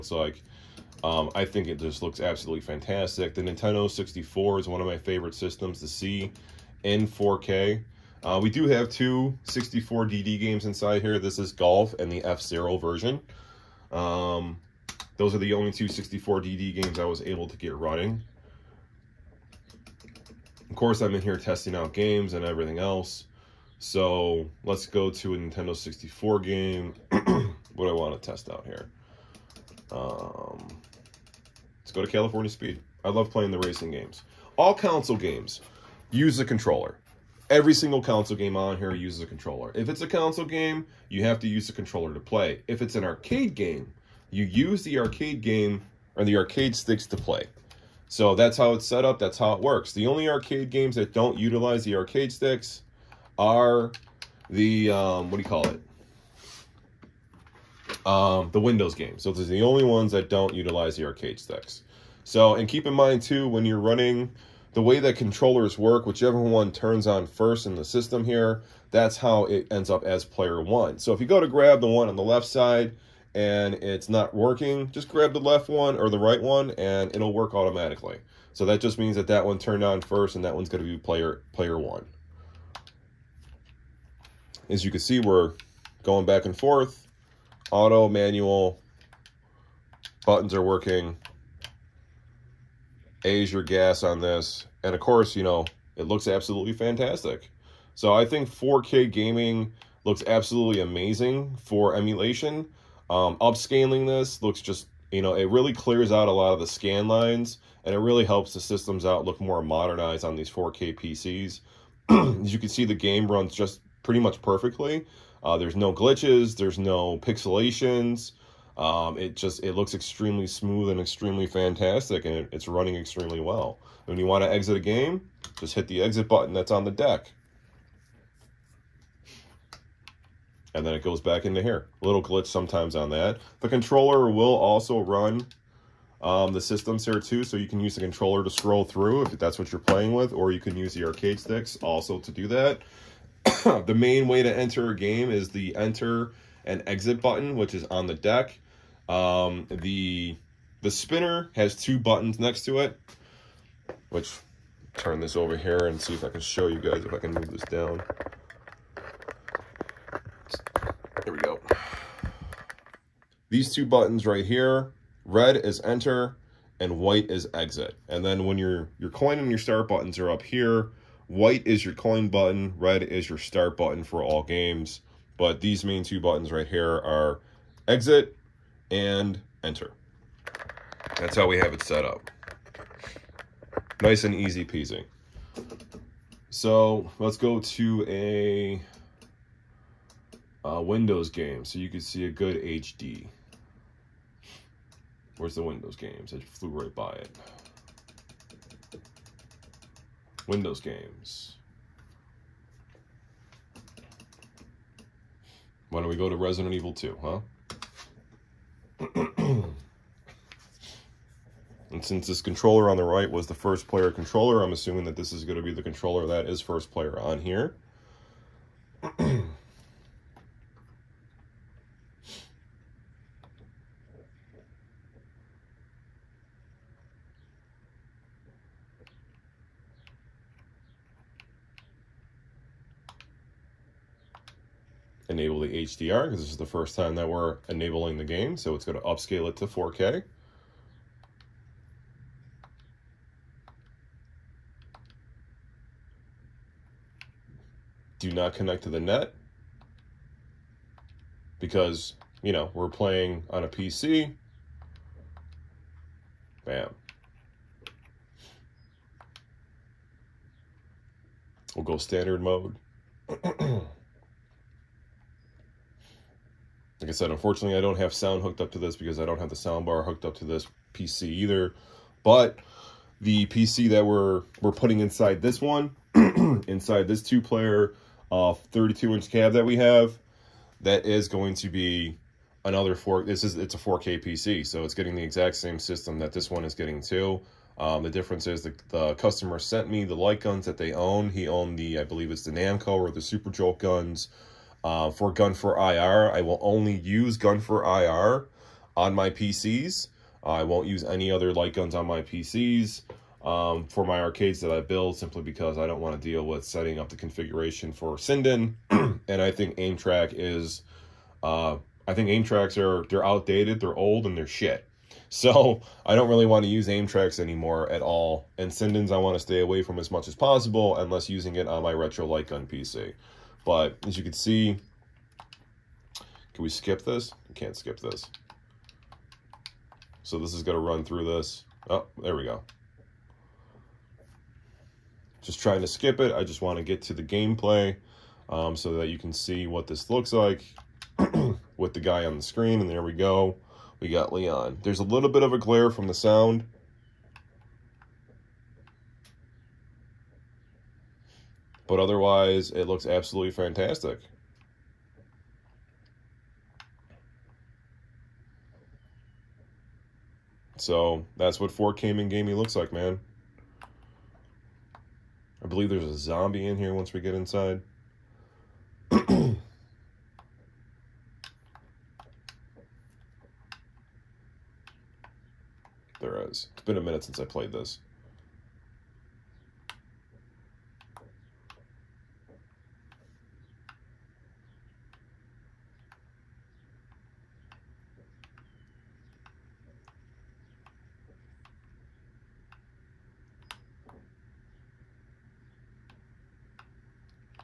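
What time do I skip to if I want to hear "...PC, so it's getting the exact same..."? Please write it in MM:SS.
04:44.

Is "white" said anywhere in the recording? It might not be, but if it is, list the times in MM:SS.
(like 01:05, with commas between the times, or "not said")
02:46, 02:51.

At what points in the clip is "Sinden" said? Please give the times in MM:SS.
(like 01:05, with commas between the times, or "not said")
05:08, 05:18.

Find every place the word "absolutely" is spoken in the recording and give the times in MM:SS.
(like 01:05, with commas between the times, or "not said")
00:02, 01:36, 01:40, 05:53.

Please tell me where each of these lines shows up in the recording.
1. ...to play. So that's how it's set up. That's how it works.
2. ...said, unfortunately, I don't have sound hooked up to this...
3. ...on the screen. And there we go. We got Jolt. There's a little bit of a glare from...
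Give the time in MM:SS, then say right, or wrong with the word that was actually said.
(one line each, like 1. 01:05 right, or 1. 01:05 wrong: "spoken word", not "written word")
1. 00:47 right
2. 04:27 right
3. 05:42 wrong: "Leon", not "Jolt".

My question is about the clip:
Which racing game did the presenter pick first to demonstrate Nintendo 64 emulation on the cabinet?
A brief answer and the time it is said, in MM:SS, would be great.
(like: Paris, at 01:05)
California Speed, at 00:32.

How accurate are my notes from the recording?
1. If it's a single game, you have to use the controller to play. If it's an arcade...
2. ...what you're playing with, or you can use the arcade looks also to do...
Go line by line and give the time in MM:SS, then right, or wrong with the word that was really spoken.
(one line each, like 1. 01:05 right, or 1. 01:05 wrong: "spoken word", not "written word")
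1. 00:39 wrong: "console", not "single"
2. 02:19 wrong: "sticks", not "looks".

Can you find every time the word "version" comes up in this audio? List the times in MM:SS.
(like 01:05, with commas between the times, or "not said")
00:12.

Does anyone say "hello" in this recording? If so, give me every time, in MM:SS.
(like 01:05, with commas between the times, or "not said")
not said.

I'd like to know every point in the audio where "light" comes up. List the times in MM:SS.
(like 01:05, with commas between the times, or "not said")
04:50, 05:01, 05:22.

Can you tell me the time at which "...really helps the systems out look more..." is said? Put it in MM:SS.
01:47.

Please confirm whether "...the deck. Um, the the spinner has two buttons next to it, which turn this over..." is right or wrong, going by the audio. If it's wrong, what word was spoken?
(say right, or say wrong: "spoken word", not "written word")
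right.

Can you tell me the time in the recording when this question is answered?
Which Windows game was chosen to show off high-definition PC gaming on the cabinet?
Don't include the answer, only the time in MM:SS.
03:26.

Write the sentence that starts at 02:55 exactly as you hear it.
But these main two buttons right here are exit and enter.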